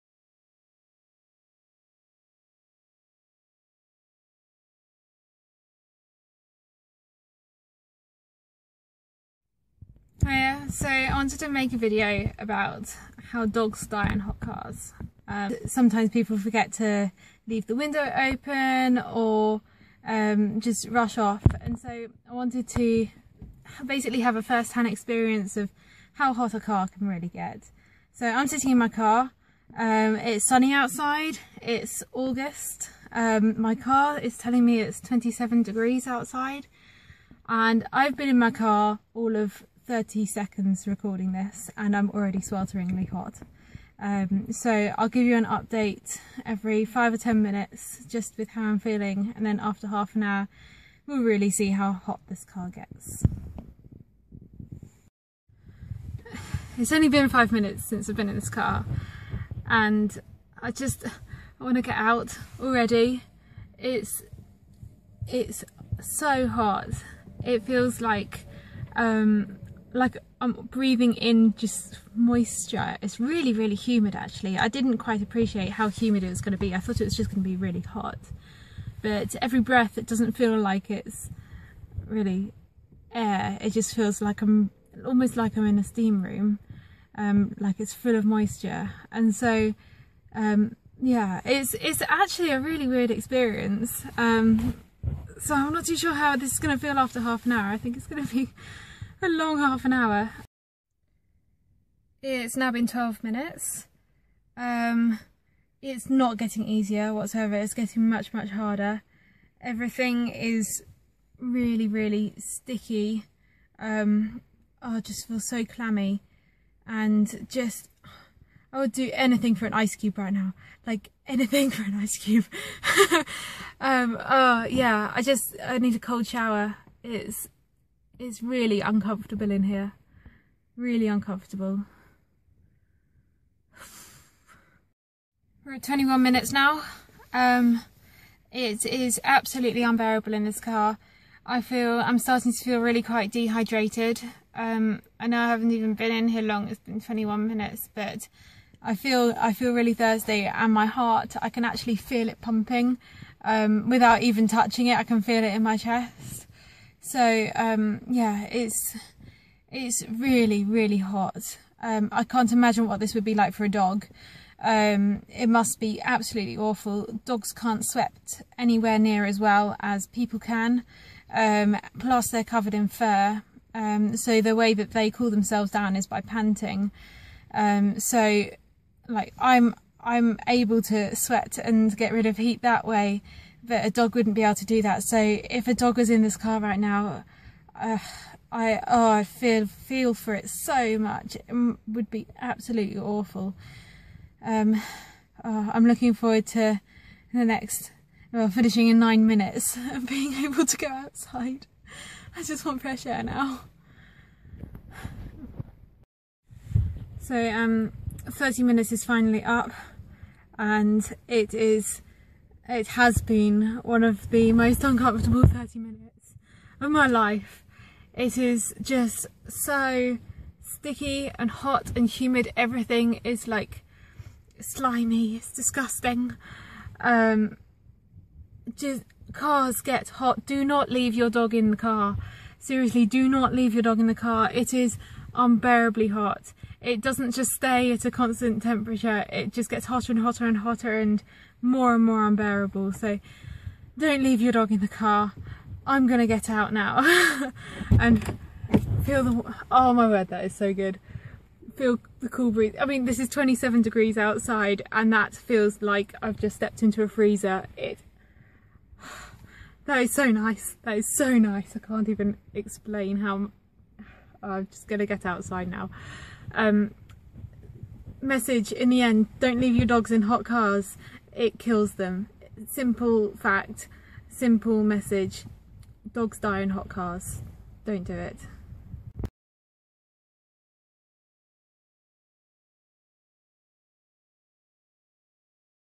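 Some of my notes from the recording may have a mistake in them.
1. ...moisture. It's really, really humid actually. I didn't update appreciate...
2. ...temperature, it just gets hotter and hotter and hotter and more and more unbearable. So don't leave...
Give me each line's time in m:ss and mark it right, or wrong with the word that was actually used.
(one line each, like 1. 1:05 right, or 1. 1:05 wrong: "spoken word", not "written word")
1. 1:12 wrong: "quite", not "update"
2. 3:58 right.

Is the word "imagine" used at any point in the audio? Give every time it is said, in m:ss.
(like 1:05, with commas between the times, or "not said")
2:42.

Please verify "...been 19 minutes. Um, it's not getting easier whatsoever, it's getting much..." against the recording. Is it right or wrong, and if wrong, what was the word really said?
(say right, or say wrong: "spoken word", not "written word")
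wrong: "12", not "19".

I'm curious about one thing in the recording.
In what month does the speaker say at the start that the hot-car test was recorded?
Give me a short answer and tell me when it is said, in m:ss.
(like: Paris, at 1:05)
August, at 0:32.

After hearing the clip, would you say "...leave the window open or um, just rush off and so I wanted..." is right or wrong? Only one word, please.
right.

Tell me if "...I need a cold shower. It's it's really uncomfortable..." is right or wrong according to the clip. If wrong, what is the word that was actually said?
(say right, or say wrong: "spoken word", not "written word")
right.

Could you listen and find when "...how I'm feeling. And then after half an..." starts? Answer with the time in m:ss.
0:48.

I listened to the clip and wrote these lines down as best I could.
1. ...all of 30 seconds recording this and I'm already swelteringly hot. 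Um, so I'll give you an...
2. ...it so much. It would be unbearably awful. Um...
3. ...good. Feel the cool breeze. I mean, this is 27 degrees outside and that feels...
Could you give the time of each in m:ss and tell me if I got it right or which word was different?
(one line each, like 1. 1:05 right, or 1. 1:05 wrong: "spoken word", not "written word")
1. 0:39 right
2. 3:10 wrong: "absolutely", not "unbearably"
3. 4:10 right.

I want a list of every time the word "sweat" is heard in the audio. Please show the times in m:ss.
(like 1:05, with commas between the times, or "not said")
2:47, 3:01.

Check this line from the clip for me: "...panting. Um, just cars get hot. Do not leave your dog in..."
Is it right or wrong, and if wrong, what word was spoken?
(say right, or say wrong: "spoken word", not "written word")
wrong: "disgusting", not "panting".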